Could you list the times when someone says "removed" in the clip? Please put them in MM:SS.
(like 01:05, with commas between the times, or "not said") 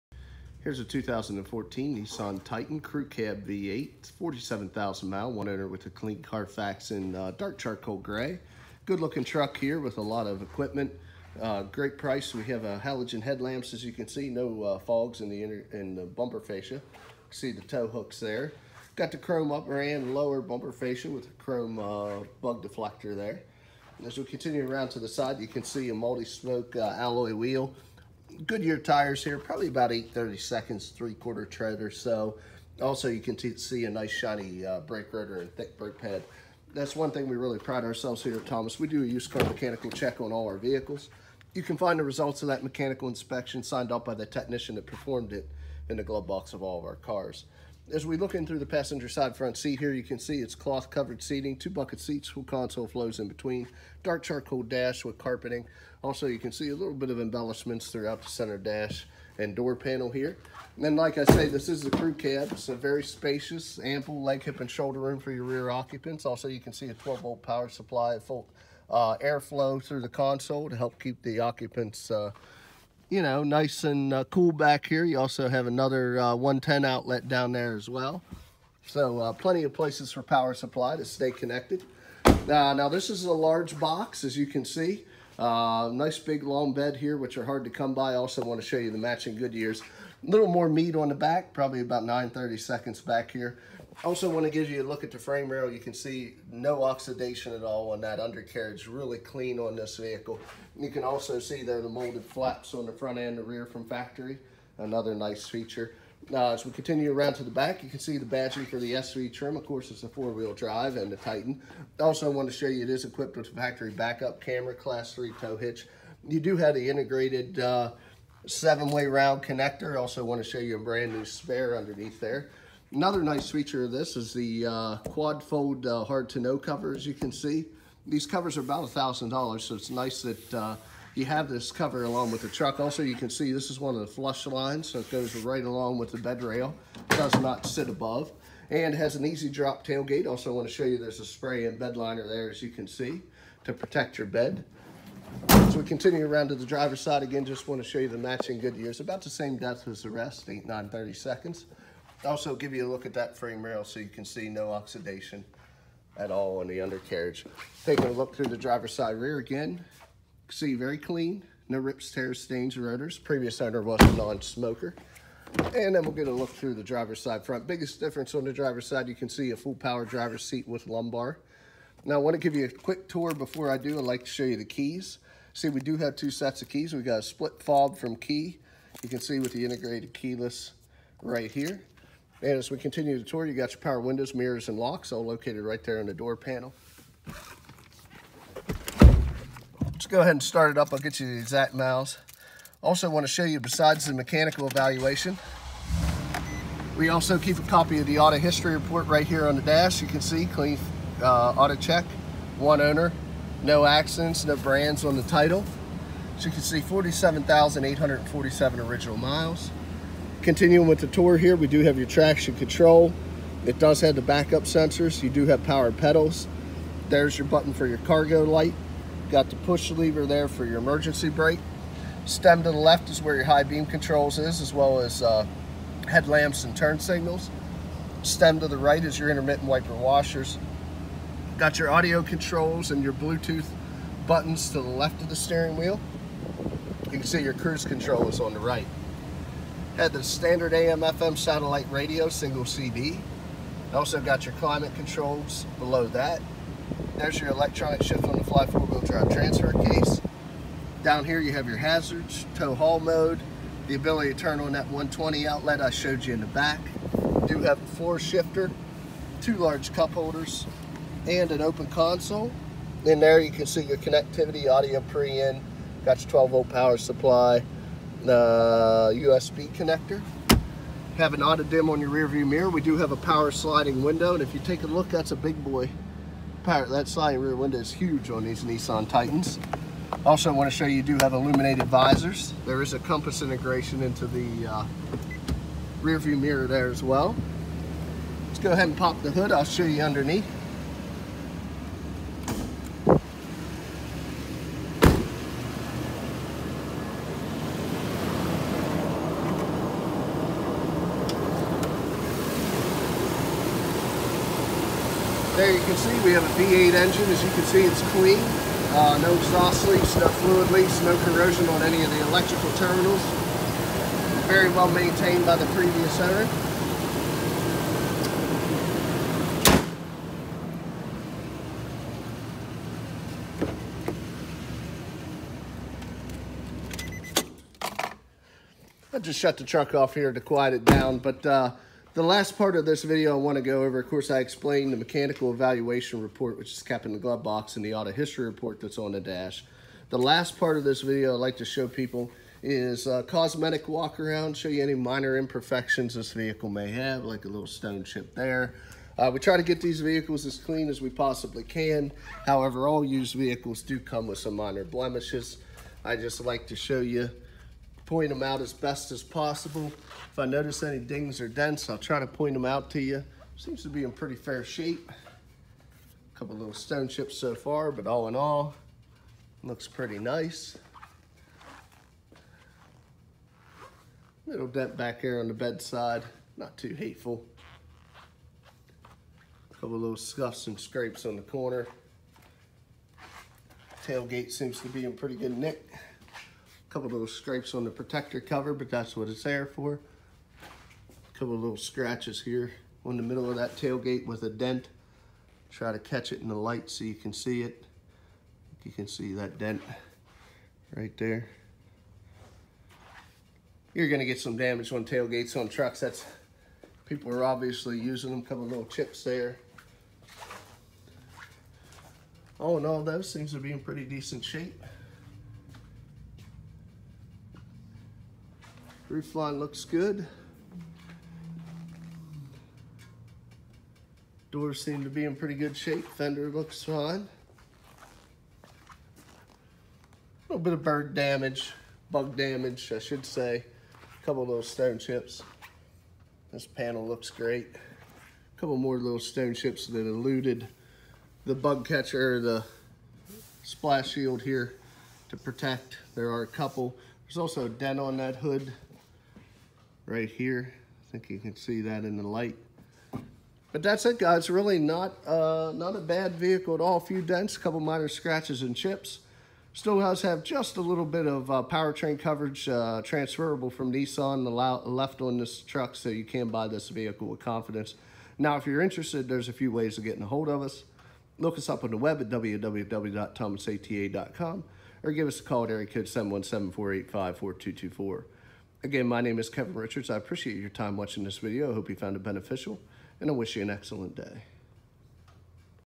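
not said.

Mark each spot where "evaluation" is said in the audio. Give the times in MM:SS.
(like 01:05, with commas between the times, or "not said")
03:14, 05:35.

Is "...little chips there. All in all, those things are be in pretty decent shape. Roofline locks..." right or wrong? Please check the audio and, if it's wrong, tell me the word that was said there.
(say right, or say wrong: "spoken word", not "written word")
wrong: "looks", not "locks".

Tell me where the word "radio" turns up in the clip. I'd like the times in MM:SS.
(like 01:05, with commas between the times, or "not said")
04:01.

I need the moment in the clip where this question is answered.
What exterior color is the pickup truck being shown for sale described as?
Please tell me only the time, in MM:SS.
00:07.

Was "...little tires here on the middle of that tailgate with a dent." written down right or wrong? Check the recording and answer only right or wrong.
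wrong.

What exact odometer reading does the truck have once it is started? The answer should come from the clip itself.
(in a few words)
47,847 miles.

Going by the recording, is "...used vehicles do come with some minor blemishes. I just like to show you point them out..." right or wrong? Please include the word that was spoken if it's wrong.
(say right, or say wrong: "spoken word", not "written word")
right.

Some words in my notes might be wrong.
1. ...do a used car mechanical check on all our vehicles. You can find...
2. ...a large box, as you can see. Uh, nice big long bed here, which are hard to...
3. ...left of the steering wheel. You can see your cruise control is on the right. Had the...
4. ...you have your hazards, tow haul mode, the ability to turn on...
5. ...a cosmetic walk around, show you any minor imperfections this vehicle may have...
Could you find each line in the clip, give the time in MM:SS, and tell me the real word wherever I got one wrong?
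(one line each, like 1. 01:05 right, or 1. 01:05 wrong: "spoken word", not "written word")
1. 00:38 right
2. 01:23 right
3. 03:54 right
4. 04:11 right
5. 05:43 right.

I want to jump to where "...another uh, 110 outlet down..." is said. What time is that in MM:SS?
01:15.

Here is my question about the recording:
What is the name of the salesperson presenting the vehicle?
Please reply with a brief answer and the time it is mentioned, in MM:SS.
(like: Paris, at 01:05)
Kevin Richards, at 07:59.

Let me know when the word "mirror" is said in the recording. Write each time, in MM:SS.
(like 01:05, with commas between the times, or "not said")
03:04, 04:32, 04:46.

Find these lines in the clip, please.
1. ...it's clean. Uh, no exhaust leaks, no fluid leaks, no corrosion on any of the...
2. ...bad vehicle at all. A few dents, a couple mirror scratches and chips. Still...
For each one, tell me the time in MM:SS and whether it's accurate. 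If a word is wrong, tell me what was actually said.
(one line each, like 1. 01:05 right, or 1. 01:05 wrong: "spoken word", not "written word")
1. 05:07 right
2. 07:36 wrong: "minor", not "mirror".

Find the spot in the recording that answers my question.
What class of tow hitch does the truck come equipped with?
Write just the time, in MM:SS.
01:54.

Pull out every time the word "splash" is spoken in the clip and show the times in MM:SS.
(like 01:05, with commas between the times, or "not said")
07:23.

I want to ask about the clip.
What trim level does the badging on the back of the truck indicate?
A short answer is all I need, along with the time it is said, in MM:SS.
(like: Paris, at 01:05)
SV, at 01:48.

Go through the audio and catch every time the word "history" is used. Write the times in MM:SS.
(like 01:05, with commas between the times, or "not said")
03:18, 05:38.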